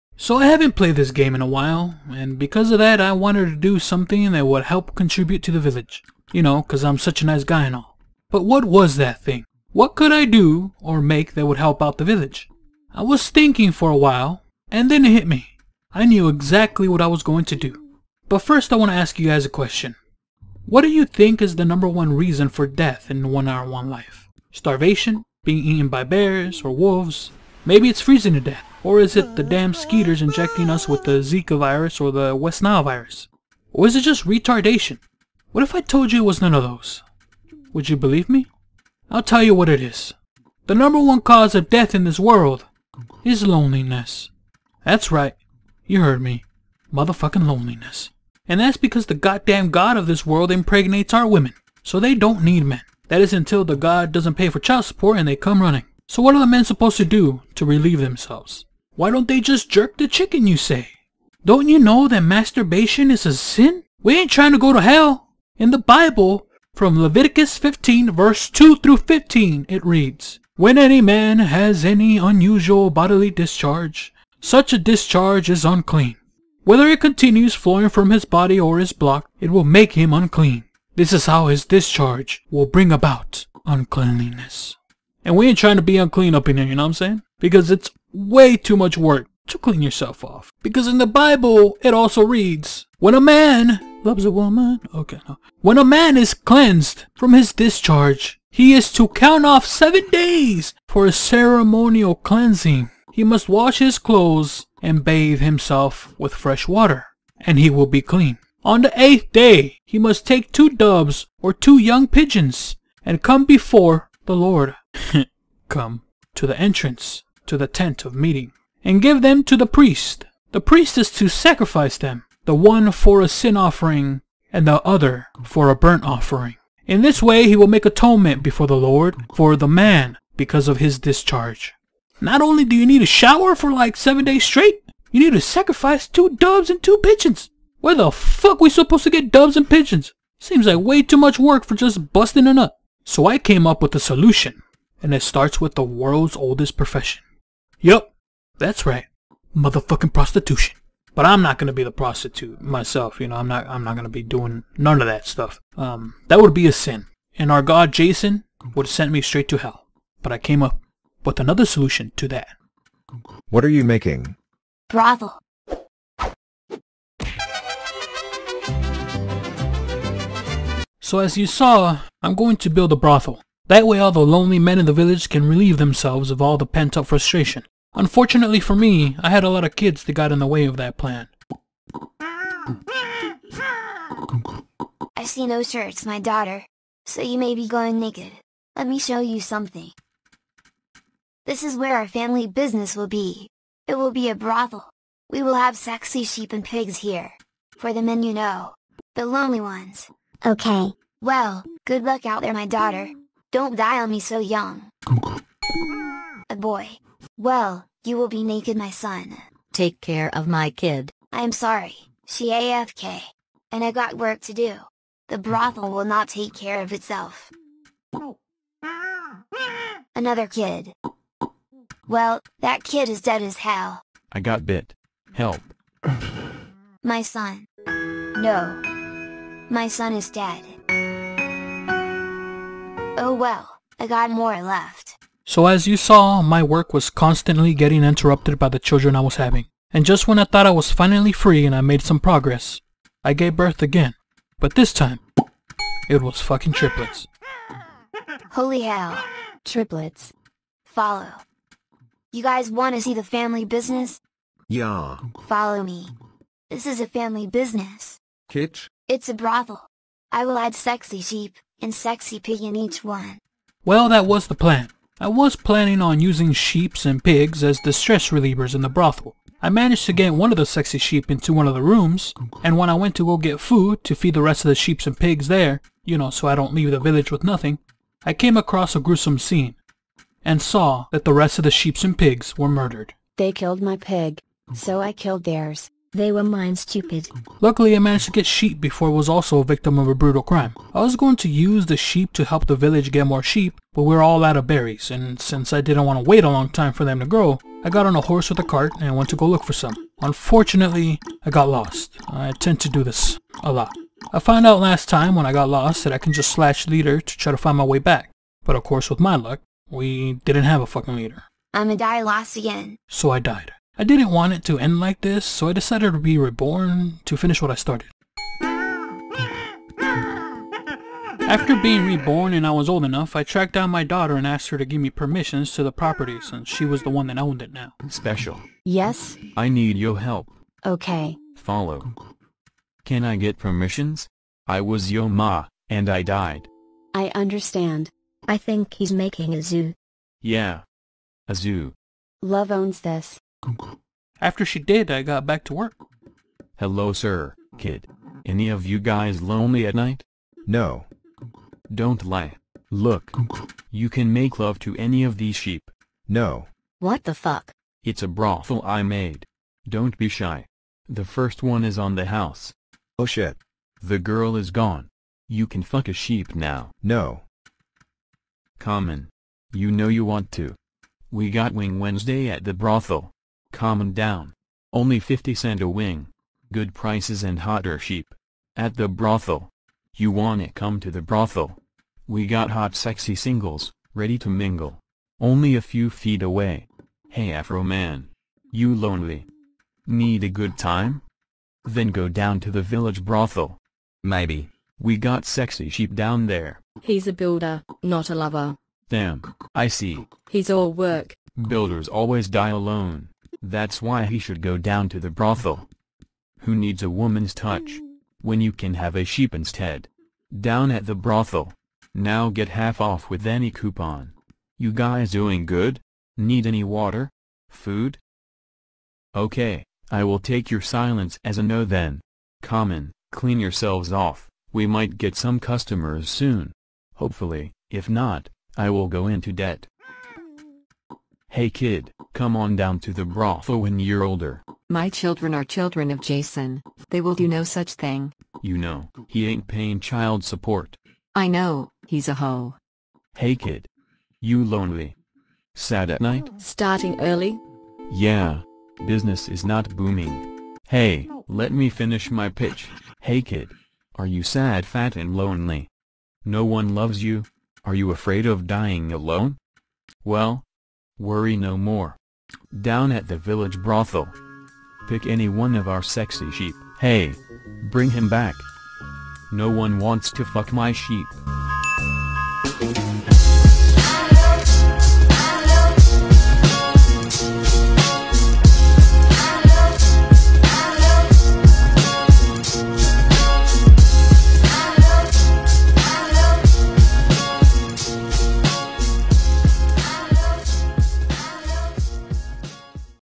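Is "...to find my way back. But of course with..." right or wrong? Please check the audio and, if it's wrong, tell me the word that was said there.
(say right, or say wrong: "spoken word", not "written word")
right.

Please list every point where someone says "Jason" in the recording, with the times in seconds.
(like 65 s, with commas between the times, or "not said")
157 s, 436 s.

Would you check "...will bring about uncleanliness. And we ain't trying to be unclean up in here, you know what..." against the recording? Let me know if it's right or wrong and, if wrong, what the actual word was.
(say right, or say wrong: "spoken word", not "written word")
right.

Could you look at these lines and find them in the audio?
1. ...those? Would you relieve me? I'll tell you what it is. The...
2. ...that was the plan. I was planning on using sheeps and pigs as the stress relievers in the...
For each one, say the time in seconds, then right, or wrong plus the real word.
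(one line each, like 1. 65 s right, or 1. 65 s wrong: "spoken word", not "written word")
1. 36 s wrong: "believe", not "relieve"
2. 264 s right.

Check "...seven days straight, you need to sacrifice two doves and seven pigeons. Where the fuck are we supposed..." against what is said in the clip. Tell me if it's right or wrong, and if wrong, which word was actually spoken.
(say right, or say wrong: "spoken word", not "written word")
wrong: "two", not "seven".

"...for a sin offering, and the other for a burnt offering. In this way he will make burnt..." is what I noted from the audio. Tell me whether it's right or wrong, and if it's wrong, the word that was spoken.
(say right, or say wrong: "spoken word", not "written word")
wrong: "atonement", not "burnt".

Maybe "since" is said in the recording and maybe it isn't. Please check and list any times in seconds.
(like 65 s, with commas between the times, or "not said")
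295 s, 326 s.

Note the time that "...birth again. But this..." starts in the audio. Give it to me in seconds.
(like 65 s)
243 s.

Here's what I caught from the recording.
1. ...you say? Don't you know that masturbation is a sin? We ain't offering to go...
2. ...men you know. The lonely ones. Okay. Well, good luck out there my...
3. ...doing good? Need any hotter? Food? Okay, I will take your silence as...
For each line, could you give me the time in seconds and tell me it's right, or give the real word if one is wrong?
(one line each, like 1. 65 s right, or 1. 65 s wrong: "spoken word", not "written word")
1. 60 s wrong: "trying", not "offering"
2. 198 s right
3. 415 s wrong: "water", not "hotter".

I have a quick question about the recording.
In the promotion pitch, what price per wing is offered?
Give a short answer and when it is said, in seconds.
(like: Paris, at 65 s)
50 cents, at 375 s.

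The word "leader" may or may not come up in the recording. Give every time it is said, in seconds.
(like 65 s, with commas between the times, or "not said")
306 s, 311 s.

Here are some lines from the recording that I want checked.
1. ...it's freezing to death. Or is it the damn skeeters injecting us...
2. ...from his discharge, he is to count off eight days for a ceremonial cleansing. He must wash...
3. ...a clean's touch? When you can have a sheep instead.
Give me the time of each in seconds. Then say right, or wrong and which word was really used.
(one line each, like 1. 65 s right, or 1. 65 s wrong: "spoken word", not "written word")
1. 27 s right
2. 97 s wrong: "seven", not "eight"
3. 407 s wrong: "woman", not "clean".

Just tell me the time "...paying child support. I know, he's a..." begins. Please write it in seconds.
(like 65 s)
439 s.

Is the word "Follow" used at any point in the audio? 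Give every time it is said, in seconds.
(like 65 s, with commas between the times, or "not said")
250 s, 255 s, 331 s.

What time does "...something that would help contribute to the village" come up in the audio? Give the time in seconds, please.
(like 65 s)
3 s.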